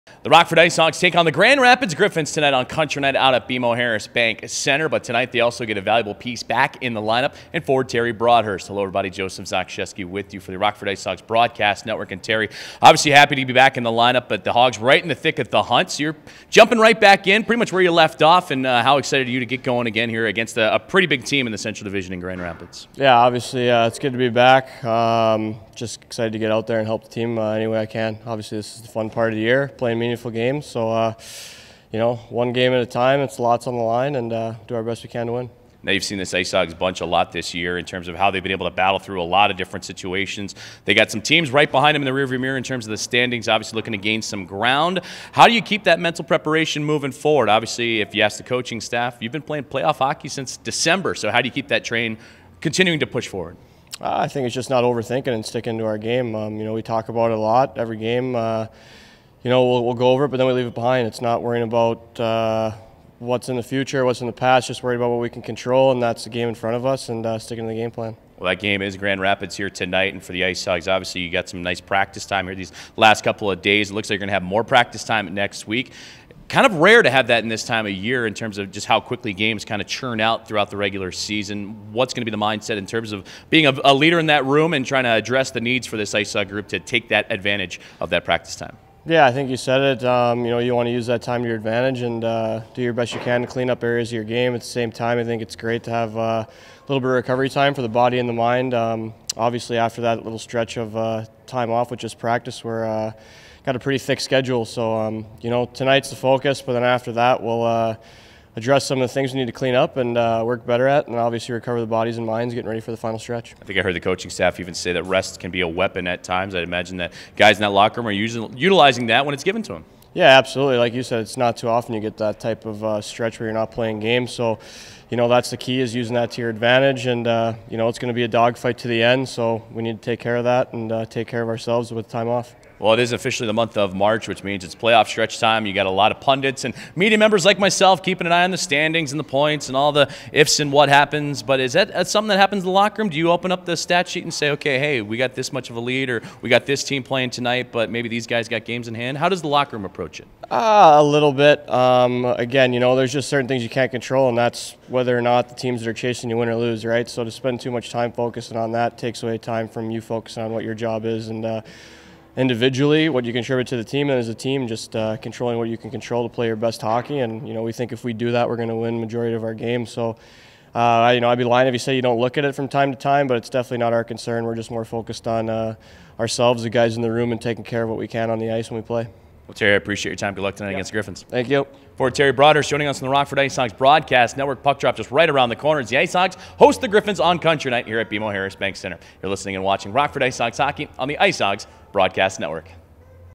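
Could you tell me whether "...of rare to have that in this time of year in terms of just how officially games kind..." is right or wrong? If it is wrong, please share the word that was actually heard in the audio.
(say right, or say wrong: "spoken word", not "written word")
wrong: "quickly", not "officially".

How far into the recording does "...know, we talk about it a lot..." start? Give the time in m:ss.
0:56.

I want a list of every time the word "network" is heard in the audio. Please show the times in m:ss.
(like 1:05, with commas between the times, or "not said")
0:11, 3:04, 3:12.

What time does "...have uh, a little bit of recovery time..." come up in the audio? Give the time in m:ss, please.
1:35.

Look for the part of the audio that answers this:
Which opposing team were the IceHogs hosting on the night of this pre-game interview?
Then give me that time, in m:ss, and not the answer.
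0:01.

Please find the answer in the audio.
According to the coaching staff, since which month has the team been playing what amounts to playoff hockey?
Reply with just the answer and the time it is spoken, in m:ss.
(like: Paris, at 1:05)
December, at 0:50.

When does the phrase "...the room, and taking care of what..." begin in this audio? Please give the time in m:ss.
2:57.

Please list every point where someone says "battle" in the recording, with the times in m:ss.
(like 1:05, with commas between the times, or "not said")
0:38.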